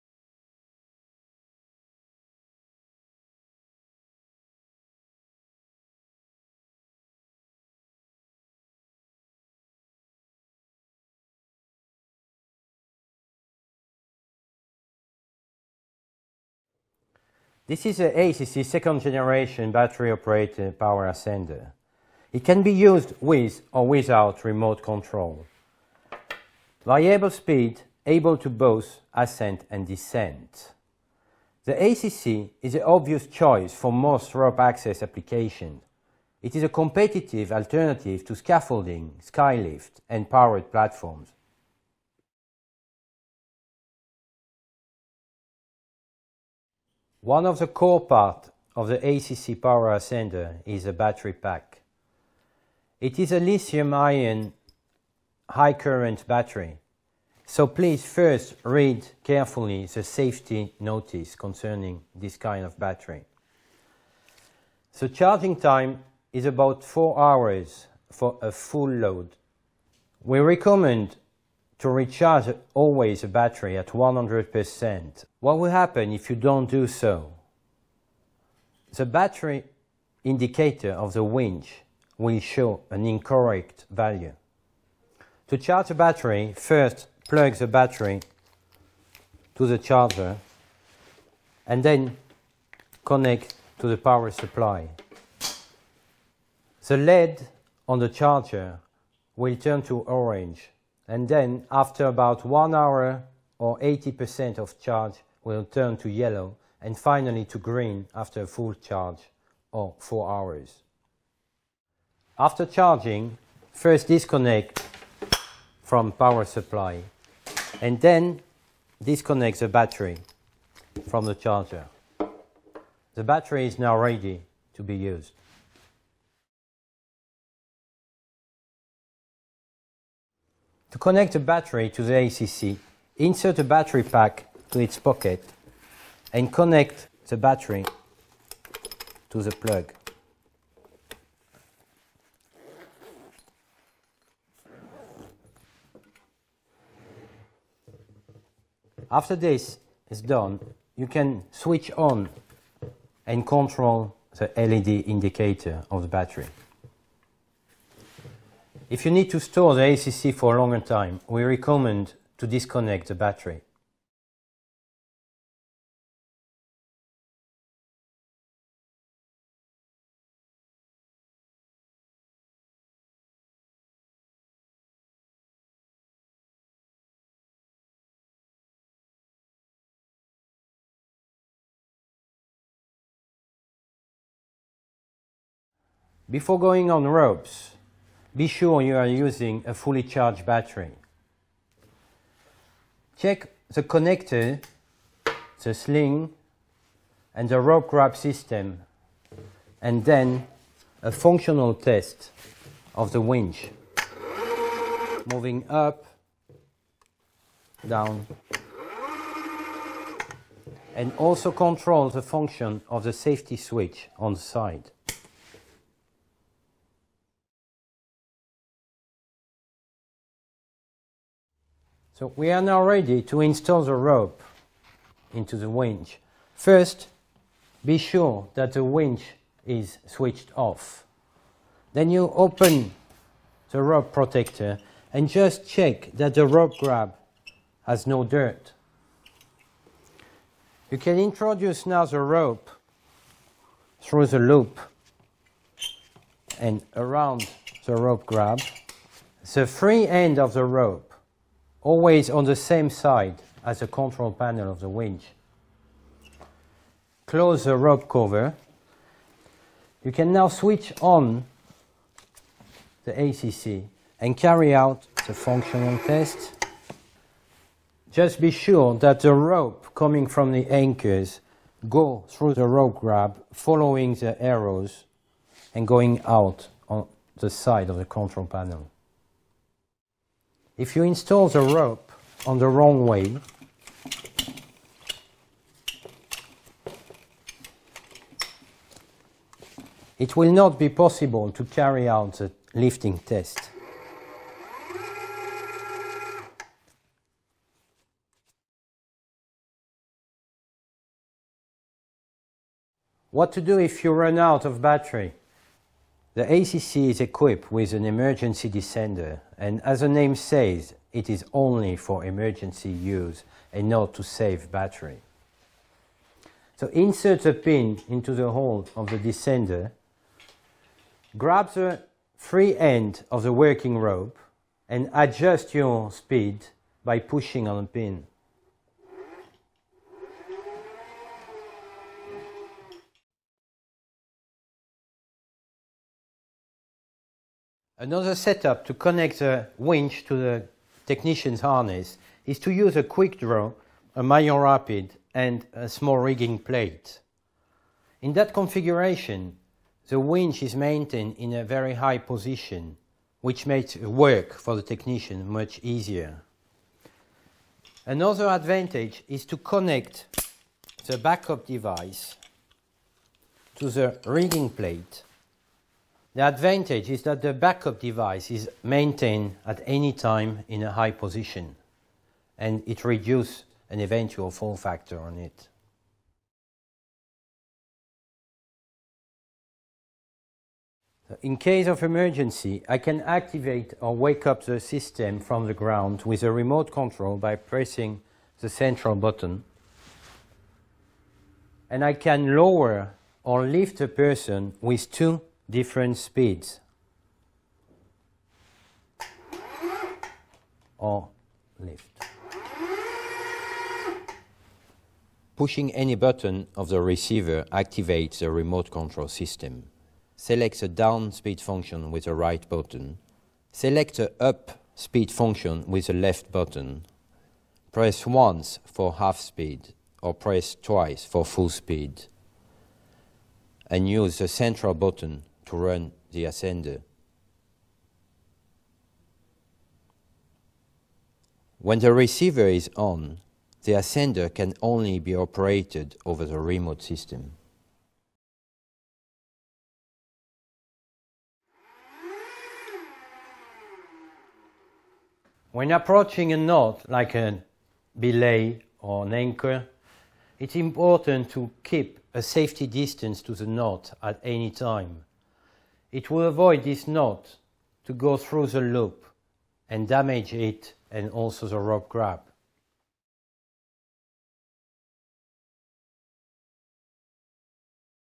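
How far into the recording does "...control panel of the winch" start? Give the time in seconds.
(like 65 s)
253 s.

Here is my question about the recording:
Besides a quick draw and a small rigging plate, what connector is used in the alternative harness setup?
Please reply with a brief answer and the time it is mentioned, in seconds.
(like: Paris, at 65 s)
Maillon Rapide, at 344 s.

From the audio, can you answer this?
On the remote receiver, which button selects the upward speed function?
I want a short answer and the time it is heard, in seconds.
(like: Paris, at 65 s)
Left button, at 416 s.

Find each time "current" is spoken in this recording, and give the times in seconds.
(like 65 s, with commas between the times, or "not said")
55 s.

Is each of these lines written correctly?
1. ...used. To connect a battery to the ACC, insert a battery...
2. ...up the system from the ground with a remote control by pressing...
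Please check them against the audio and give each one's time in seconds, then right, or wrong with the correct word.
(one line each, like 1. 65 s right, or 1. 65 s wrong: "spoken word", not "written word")
1. 124 s right
2. 384 s right.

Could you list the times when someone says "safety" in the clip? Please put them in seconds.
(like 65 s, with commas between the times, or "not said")
60 s, 213 s, 452 s.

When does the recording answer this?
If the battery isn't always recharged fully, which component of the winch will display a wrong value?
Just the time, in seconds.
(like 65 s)
79 s.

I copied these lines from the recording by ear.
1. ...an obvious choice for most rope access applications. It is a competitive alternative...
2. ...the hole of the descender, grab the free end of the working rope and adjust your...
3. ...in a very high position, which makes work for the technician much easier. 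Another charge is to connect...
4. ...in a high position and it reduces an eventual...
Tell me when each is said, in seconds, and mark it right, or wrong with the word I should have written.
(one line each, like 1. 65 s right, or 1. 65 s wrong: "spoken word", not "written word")
1. 32 s right
2. 318 s right
3. 351 s wrong: "advantage", not "charge"
4. 370 s right.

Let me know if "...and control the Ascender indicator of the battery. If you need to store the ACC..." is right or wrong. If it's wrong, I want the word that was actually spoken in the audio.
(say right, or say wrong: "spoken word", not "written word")
wrong: "LED", not "Ascender".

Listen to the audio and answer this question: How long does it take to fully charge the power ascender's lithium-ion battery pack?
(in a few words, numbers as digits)
4 hours.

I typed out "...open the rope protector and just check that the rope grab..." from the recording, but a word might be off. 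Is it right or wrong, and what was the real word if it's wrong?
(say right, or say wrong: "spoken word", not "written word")
right.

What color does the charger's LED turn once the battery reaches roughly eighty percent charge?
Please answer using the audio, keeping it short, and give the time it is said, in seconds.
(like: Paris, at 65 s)
Yellow, at 106 s.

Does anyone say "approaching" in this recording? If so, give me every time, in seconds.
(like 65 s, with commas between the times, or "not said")
445 s.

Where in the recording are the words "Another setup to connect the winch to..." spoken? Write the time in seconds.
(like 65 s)
338 s.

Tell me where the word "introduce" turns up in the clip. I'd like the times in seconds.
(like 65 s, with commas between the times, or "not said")
241 s.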